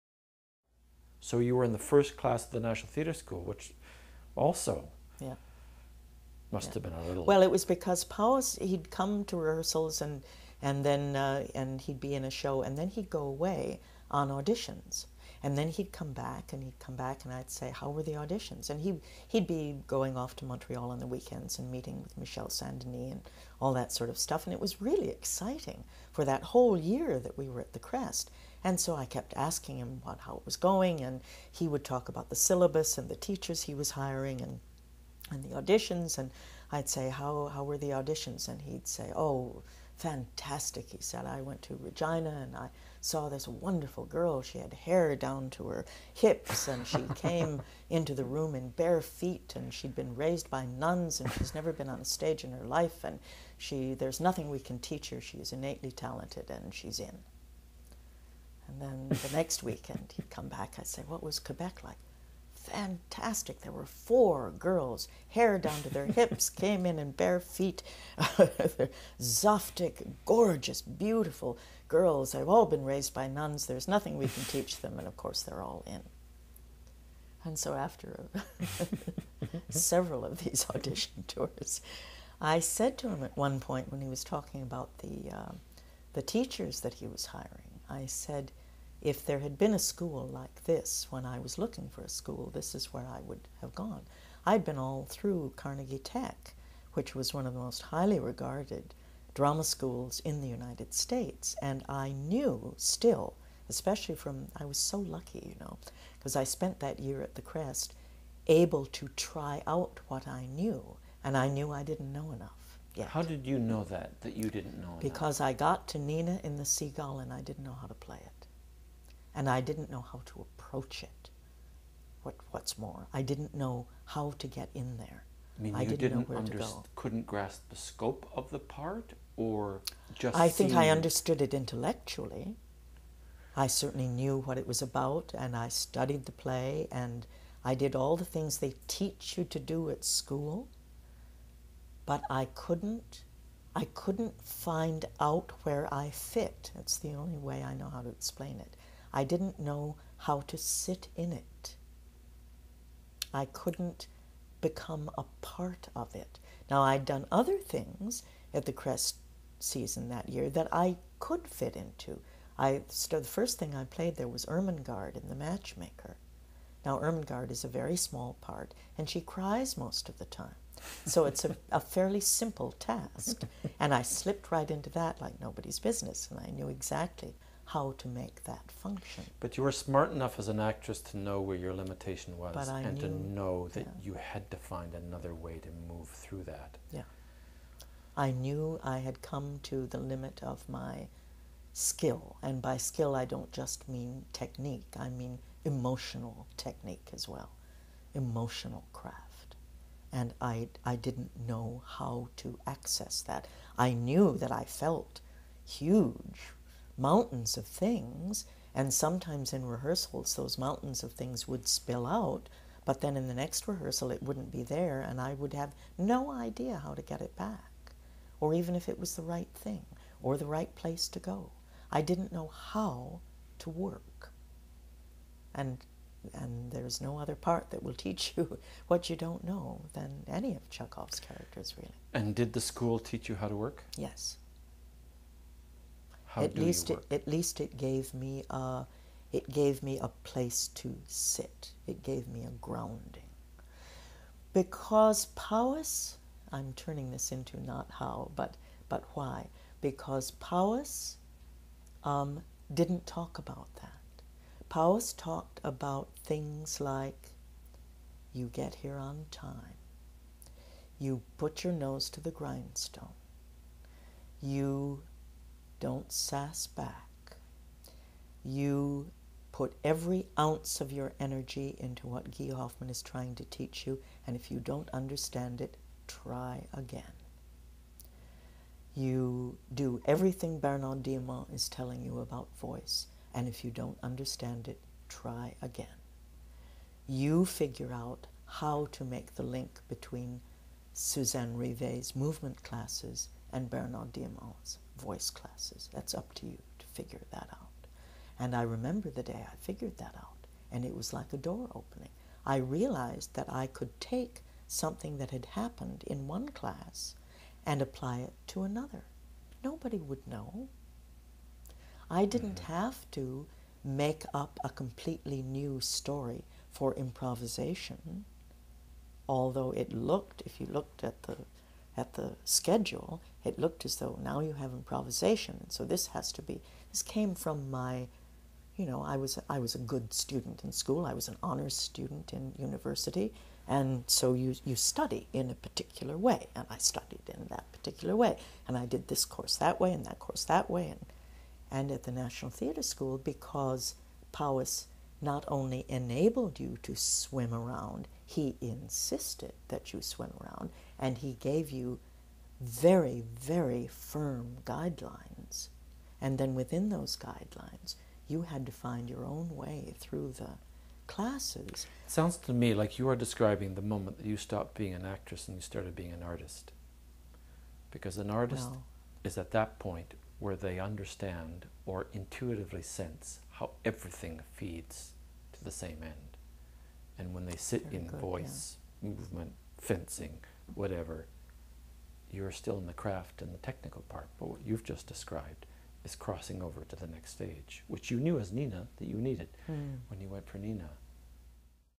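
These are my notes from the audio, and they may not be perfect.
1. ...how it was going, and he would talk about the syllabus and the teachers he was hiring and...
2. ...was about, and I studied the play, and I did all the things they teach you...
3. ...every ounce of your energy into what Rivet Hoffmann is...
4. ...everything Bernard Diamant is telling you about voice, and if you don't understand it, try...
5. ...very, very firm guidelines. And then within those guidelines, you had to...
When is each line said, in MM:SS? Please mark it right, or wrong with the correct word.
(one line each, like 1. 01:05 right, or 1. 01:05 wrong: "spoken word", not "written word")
1. 00:30 right
2. 02:14 right
3. 04:29 wrong: "Guy", not "Rivet"
4. 04:40 right
5. 05:52 right.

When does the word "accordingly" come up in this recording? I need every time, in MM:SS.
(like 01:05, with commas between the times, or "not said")
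not said.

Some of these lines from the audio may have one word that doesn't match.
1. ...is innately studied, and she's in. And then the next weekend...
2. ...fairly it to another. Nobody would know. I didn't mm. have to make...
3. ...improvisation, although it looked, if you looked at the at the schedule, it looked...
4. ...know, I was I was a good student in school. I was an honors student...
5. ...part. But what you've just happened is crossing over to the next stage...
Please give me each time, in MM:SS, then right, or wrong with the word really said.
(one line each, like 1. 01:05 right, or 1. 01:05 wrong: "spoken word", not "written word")
1. 00:55 wrong: "talented", not "studied"
2. 05:07 wrong: "apply", not "fairly"
3. 05:16 right
4. 05:28 right
5. 06:24 wrong: "described", not "happened".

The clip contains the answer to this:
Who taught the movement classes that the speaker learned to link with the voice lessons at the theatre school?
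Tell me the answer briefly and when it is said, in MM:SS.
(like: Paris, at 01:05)
Suzanne Rivet, at 04:50.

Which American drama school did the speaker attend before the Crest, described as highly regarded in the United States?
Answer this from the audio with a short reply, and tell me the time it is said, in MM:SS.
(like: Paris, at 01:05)
Carnegie Tech, at 01:35.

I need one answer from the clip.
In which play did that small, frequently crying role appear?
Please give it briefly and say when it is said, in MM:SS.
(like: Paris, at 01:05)
The Matchmaker, at 02:45.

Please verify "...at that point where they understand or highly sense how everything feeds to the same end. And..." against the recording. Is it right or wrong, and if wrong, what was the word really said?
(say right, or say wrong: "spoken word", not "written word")
wrong: "intuitively", not "highly".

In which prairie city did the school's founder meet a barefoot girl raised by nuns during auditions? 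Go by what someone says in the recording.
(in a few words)
Regina.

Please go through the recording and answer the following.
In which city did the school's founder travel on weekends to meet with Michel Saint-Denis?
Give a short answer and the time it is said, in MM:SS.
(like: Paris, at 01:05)
Montreal, at 00:20.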